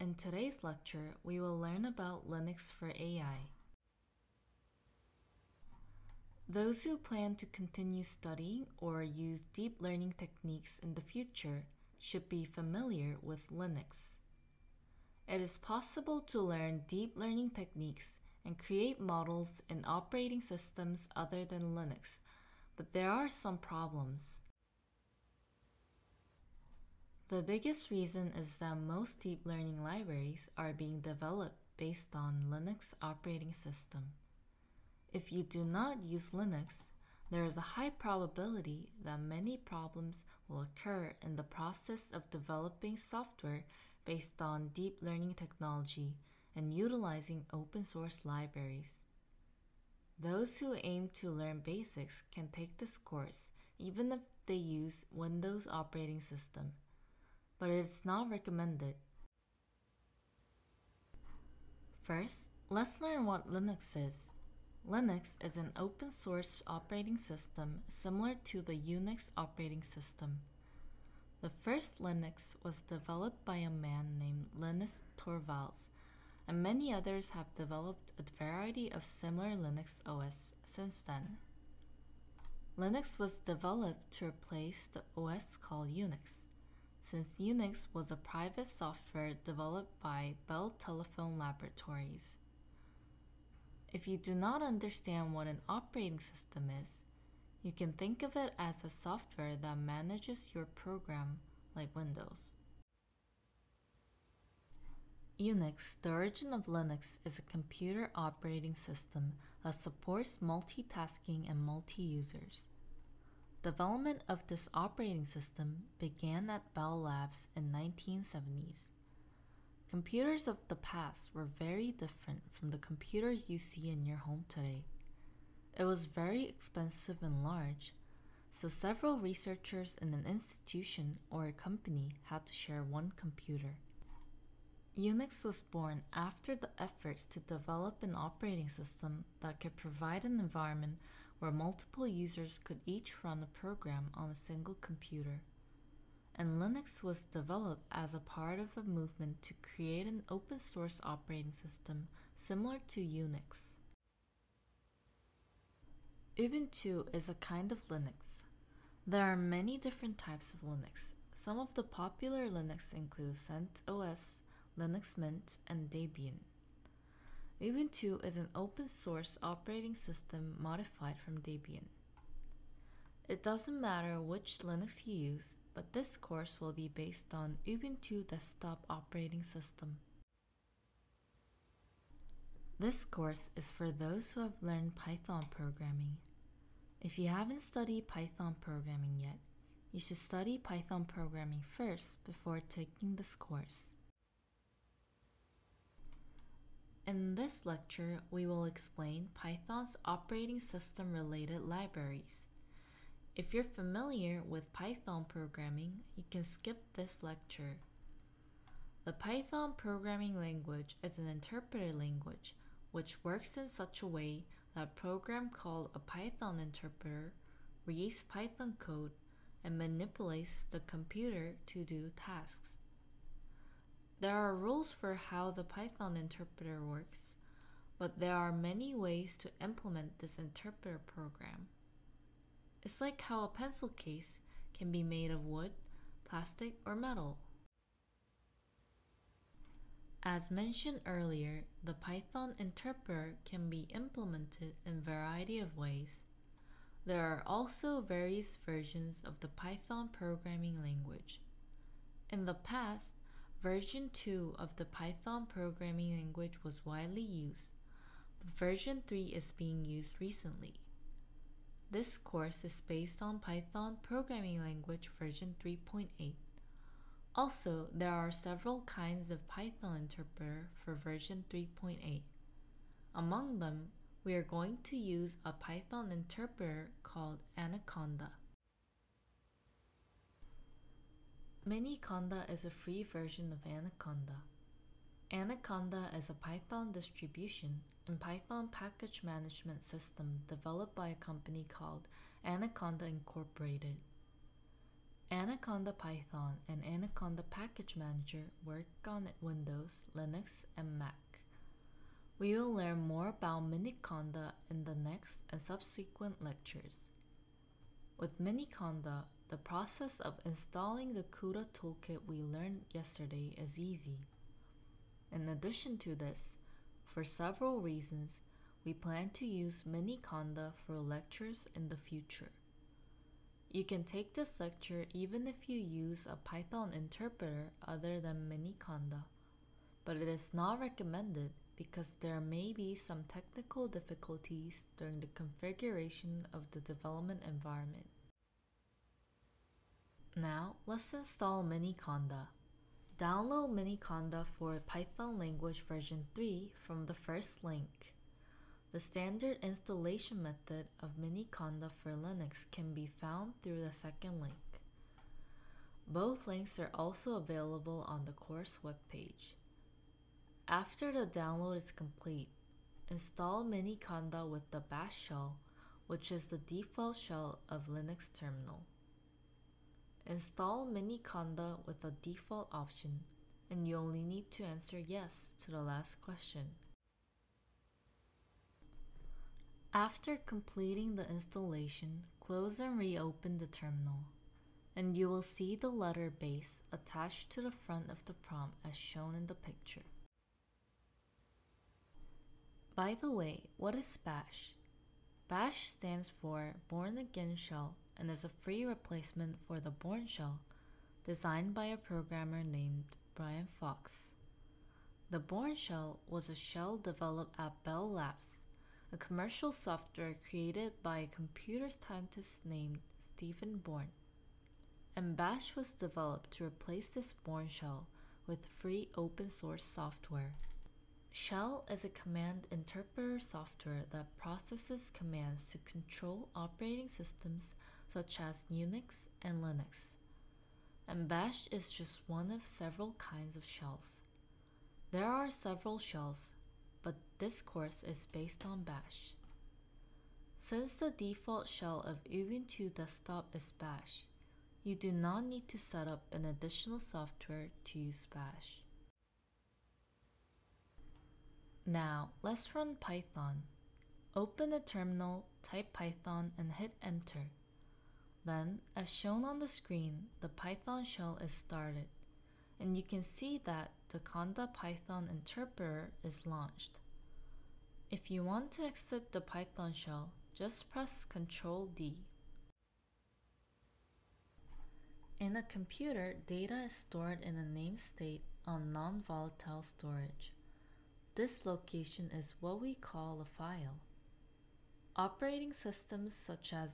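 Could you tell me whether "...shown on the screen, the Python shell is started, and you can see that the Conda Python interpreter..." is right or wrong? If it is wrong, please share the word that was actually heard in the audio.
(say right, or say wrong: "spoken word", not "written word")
right.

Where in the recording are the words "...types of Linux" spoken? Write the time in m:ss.
2:40.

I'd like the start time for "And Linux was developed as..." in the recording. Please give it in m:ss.
2:26.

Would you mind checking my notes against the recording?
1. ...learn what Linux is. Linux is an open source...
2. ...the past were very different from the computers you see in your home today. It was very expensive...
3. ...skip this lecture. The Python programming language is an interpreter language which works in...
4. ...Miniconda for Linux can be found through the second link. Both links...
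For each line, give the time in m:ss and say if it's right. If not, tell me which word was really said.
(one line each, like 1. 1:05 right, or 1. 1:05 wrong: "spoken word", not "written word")
1. 1:03 right
2. 2:00 right
3. 3:26 right
4. 5:51 right.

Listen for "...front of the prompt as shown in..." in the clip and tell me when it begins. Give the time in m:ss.
6:27.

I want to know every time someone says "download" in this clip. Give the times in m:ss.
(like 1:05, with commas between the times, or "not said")
5:43, 6:01.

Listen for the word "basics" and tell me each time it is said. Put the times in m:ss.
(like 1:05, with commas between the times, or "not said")
0:51.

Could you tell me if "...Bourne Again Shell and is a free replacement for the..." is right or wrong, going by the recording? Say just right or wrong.
right.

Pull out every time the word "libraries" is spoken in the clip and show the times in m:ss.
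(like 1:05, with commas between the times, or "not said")
0:29, 0:48, 3:21.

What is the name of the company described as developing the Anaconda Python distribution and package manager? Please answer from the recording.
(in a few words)
Anaconda Incorporated.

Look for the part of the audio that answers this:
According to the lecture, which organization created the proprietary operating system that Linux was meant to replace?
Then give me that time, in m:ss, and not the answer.
1:30.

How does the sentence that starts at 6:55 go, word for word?
And Bash was developed to replace this Bourne shell with free open source software.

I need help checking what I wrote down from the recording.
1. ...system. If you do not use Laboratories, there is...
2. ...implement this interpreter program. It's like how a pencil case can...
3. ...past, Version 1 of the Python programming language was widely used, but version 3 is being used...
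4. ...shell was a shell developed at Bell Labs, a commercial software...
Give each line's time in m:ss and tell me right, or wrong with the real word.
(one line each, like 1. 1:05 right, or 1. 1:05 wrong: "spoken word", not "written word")
1. 0:33 wrong: "Linux", not "Laboratories"
2. 3:49 right
3. 4:12 wrong: "2", not "1"
4. 6:45 right.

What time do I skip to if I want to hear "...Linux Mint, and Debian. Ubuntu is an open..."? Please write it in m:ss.
2:44.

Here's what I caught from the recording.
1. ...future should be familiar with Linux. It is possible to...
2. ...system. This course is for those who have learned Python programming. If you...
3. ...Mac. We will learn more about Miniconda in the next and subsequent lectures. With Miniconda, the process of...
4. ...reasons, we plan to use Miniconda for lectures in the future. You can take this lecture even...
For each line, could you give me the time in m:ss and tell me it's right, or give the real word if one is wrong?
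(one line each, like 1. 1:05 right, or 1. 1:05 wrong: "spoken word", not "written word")
1. 0:11 right
2. 2:59 right
3. 5:00 right
4. 5:17 right.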